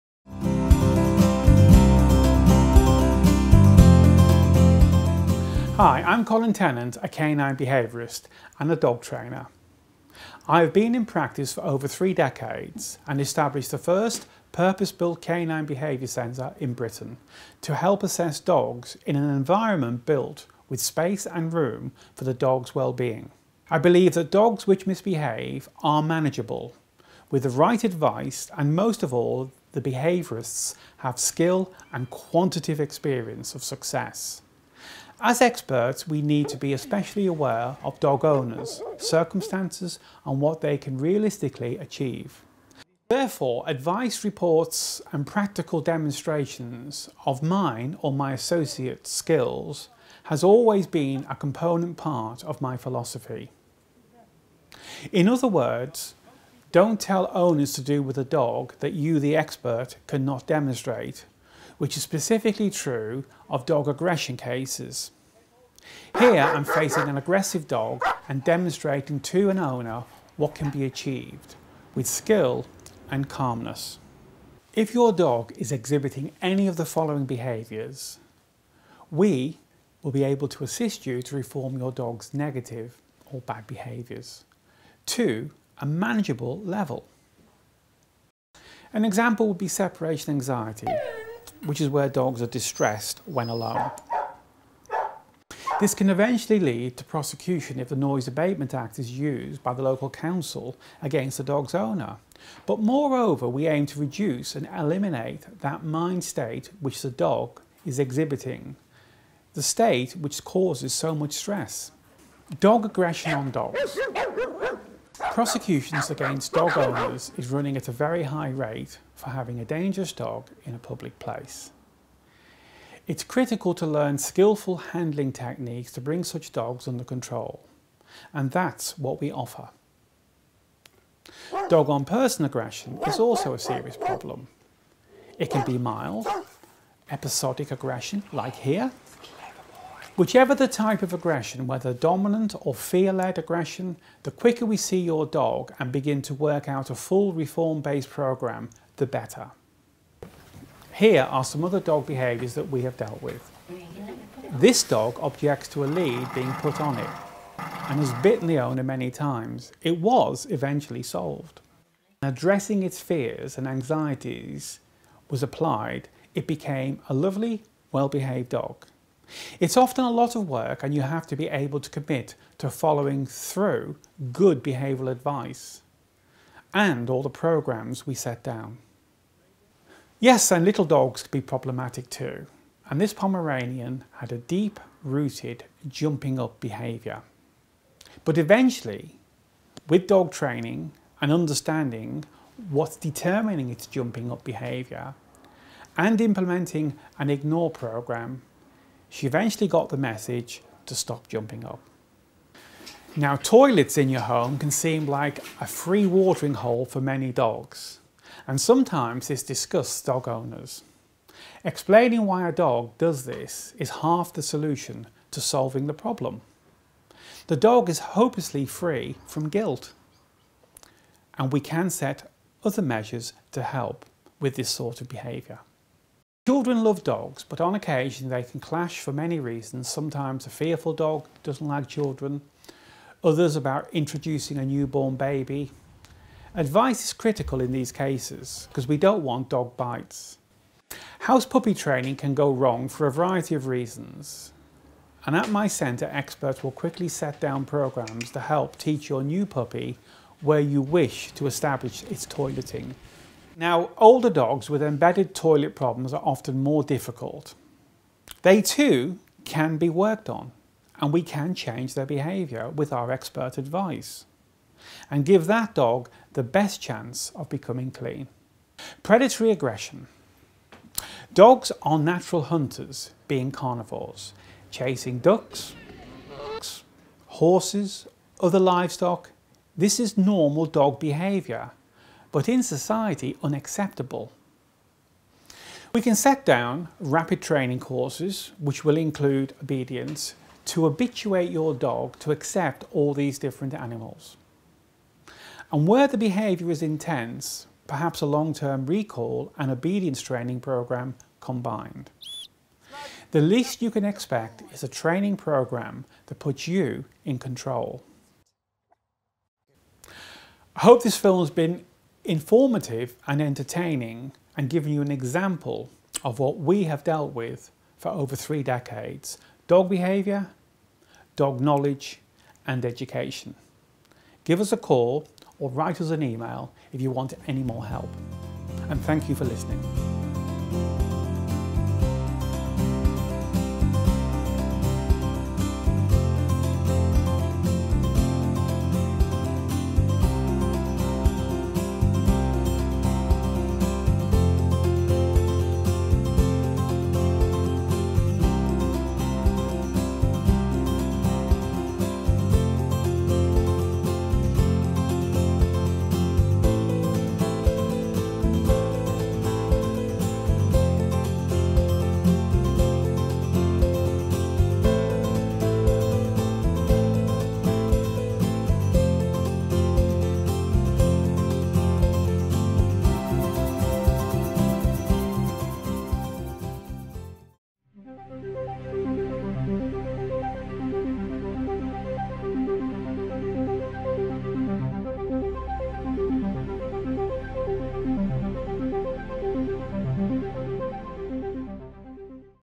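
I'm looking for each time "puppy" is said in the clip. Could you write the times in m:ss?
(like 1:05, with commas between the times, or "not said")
4:01, 4:09.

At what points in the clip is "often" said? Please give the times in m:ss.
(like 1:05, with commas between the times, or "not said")
2:49, 4:16.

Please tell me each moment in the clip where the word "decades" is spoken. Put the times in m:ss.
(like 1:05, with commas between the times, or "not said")
0:12, 5:18.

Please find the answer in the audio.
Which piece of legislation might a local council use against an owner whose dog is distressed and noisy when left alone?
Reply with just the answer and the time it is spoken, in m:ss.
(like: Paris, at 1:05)
Noise Abatement Act, at 1:37.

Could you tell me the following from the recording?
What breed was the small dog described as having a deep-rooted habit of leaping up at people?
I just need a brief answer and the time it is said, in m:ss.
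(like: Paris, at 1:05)
Pomeranian, at 3:03.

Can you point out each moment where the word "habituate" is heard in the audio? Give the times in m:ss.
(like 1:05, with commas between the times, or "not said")
4:50.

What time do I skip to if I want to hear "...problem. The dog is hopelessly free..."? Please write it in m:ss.
3:35.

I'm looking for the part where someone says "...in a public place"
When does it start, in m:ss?
2:00.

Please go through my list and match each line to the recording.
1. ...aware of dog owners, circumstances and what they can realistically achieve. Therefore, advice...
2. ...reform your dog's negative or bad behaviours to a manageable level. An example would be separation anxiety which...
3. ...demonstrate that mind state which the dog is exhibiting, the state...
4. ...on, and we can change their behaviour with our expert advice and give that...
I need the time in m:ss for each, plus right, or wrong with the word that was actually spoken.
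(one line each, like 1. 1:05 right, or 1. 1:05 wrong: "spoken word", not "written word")
1. 0:37 right
2. 1:21 right
3. 1:44 wrong: "eliminate", not "demonstrate"
4. 4:20 right.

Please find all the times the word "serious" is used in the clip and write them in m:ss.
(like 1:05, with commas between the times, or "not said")
2:13.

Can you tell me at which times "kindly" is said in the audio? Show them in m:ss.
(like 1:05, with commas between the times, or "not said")
not said.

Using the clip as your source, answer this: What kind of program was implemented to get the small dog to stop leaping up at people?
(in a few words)
ignore program.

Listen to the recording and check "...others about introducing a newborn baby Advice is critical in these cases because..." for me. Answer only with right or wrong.
right.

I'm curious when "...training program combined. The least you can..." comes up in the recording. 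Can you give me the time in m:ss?
5:00.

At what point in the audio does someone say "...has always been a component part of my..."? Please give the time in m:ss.
0:50.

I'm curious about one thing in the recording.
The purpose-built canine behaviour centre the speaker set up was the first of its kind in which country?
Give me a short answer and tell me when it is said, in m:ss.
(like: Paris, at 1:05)
Britain, at 0:16.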